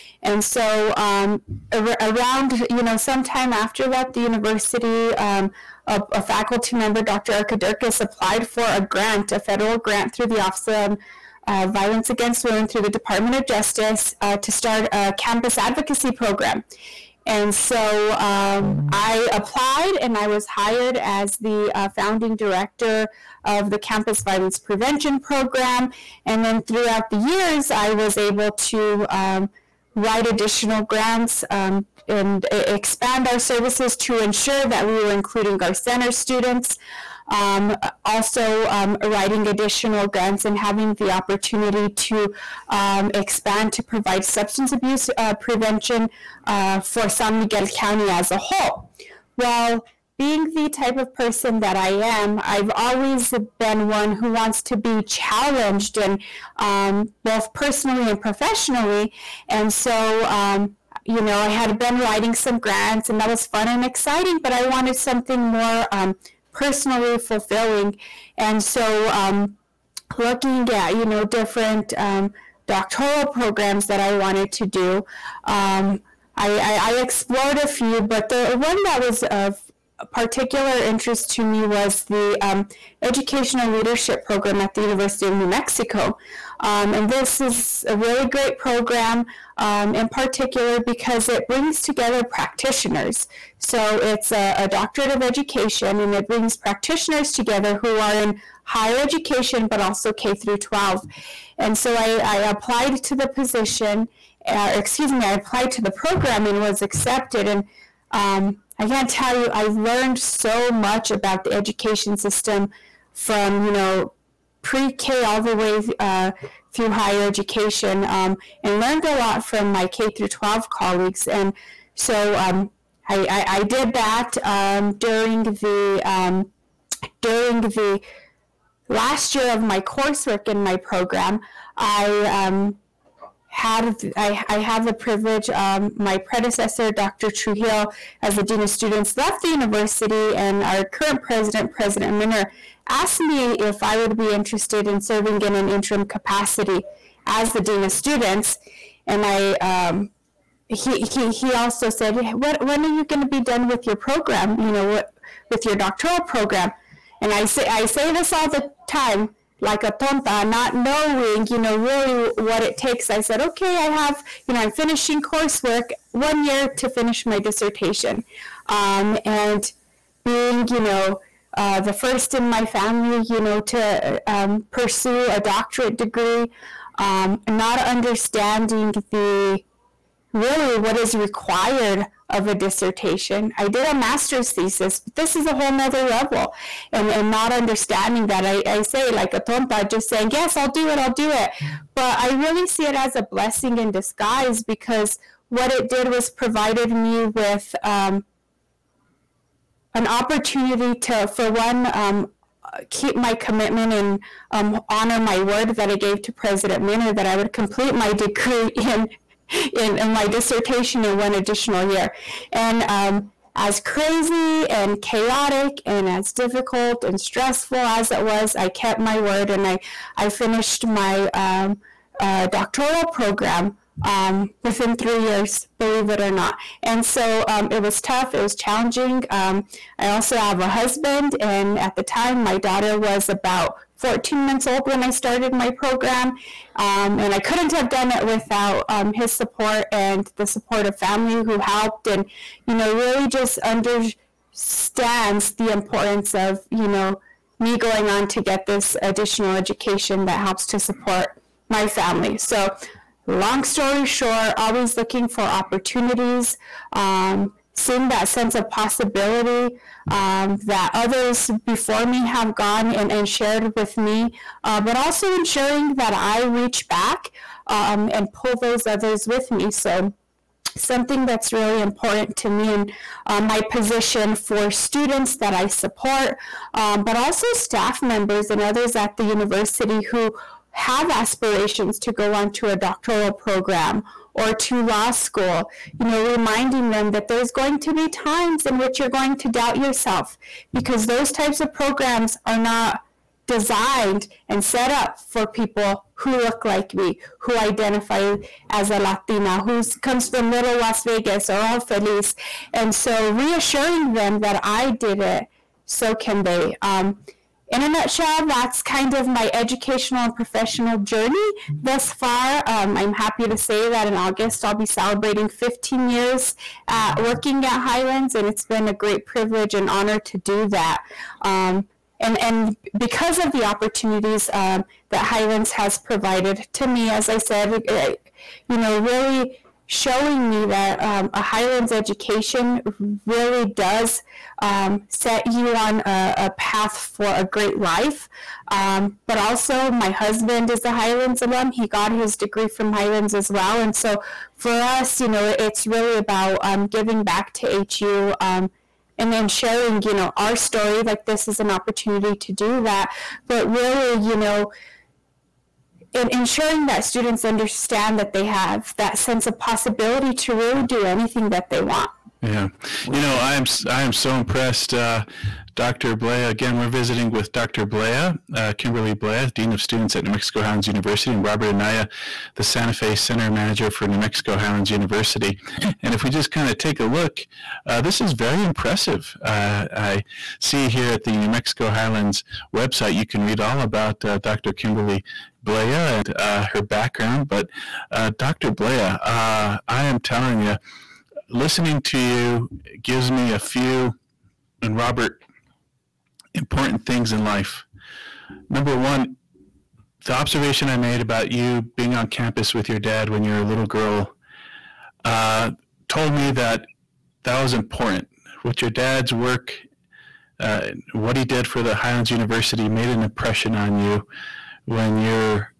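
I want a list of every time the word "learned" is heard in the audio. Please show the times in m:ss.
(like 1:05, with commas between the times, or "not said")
1:49, 1:58.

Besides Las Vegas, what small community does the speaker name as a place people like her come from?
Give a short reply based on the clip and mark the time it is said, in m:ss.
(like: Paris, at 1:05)
Ojo Feliz, at 5:01.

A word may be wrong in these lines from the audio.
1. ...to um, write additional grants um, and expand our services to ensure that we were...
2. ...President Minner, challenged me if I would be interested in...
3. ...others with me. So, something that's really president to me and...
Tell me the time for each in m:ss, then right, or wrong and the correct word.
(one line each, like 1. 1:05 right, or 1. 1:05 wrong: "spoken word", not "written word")
1. 0:28 right
2. 2:21 wrong: "asked", not "challenged"
3. 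4:28 wrong: "important", not "president".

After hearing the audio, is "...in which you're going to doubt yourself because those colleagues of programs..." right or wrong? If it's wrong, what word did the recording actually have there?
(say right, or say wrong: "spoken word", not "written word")
wrong: "types", not "colleagues".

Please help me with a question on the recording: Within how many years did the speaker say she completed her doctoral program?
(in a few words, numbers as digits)
3 years.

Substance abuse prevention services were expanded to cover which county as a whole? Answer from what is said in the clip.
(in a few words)
San Miguel County.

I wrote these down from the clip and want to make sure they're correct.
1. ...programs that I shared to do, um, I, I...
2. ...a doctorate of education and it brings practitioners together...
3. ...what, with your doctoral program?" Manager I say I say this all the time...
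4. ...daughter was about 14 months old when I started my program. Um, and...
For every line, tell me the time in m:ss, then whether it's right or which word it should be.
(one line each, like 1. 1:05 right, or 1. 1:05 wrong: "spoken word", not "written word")
1. 1:13 wrong: "wanted", not "shared"
2. 1:34 right
3. 2:34 wrong: "And", not "Manager"
4. 3:52 right.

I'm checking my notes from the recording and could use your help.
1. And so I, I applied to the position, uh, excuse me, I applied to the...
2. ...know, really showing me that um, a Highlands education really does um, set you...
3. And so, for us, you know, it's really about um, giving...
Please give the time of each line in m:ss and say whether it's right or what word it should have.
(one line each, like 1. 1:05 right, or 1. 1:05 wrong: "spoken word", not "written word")
1. 1:41 right
2. 5:28 right
3. 5:43 right.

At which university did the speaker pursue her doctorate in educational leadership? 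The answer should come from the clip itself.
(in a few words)
University of New Mexico.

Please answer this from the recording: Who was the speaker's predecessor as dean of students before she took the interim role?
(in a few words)
Dr. Trujillo.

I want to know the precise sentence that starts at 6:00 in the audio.
do anything that they want yeah.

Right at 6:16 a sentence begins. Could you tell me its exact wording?
And if we just kind of take a look, uh, this is very impressive.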